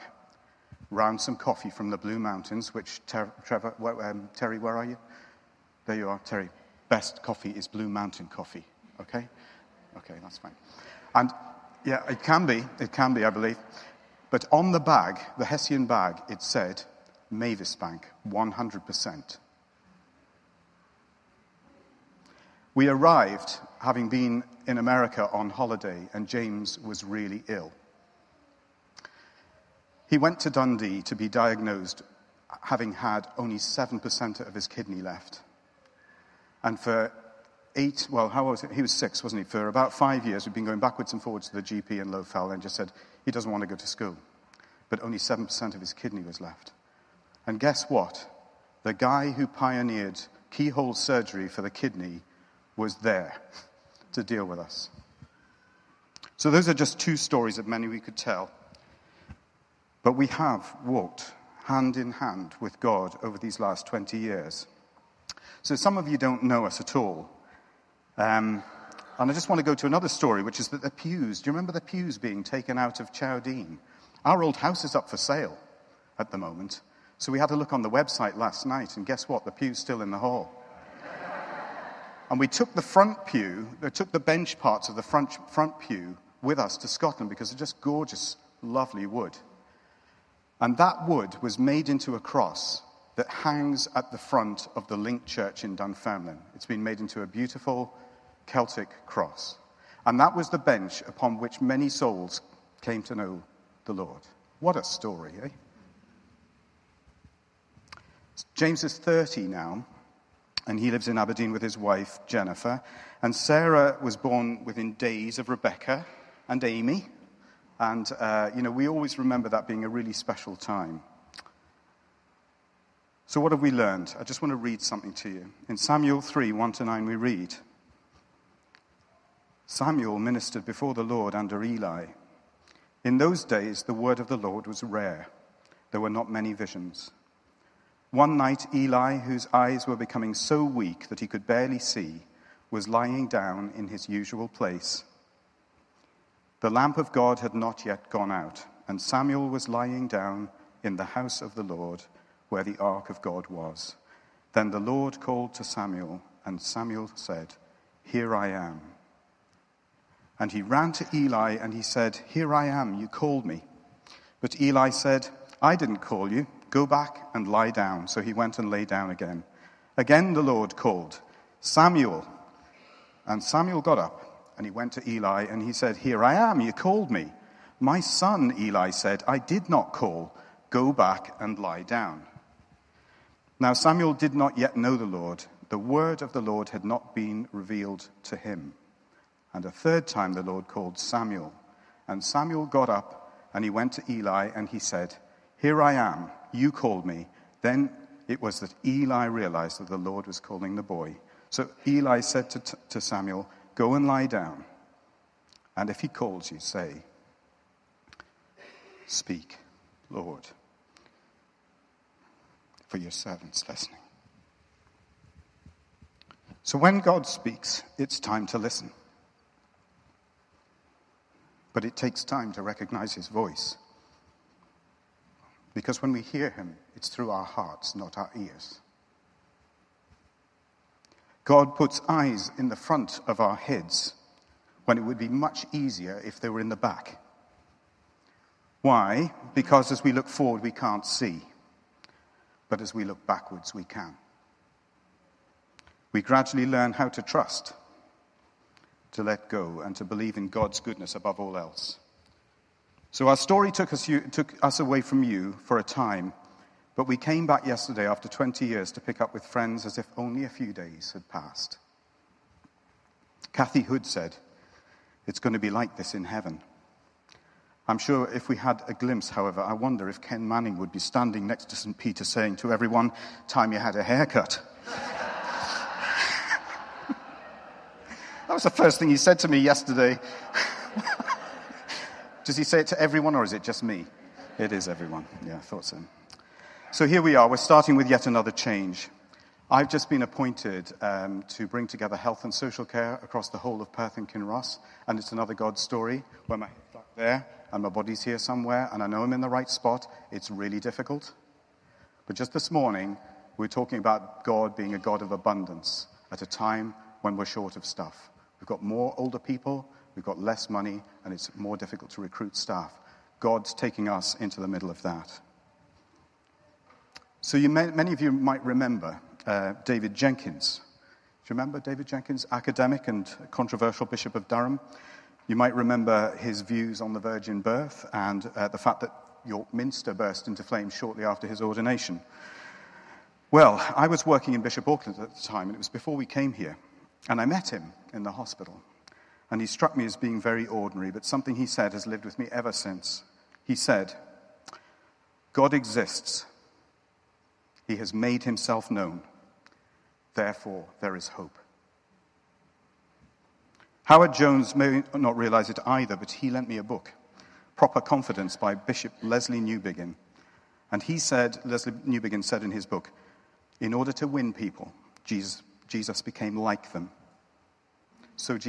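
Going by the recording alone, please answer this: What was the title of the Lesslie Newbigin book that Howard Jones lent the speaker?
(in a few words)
Proper Confidence.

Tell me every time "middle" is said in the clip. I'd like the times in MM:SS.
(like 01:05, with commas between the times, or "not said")
05:14.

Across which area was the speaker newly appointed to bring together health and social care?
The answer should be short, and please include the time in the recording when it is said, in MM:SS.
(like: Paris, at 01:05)
Perth and Kinross, at 04:53.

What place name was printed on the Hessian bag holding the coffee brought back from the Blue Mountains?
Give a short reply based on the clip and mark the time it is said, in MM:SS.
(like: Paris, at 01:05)
Mavis Bank, at 00:17.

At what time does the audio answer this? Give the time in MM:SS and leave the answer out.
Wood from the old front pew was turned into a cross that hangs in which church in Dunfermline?
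01:34.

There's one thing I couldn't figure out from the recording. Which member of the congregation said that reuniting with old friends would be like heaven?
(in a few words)
Kathy Hood.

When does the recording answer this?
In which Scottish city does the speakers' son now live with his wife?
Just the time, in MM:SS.
01:51.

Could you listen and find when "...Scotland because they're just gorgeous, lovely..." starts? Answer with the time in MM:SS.
01:26.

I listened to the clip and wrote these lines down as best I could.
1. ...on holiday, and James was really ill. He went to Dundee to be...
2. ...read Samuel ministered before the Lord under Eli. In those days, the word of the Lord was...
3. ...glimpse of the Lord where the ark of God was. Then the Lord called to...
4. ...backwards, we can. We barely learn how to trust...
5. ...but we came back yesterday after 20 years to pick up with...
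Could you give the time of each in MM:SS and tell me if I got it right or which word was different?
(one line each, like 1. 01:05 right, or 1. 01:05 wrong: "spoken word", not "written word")
1. 00:25 right
2. 02:07 right
3. 02:31 wrong: "house", not "glimpse"
4. 04:03 wrong: "gradually", not "barely"
5. 04:16 right.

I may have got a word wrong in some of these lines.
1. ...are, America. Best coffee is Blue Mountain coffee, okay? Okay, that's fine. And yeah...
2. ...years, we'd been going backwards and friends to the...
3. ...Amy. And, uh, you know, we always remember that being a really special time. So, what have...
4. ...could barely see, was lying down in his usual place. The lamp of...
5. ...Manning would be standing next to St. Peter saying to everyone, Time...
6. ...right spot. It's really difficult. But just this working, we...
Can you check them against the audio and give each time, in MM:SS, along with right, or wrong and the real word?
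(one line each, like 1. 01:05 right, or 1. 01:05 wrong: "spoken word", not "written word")
1. 00:06 wrong: "Terry", not "America"
2. 00:40 wrong: "forwards", not "friends"
3. 01:56 right
4. 02:21 right
5. 04:30 right
6. 04:59 wrong: "morning", not "working".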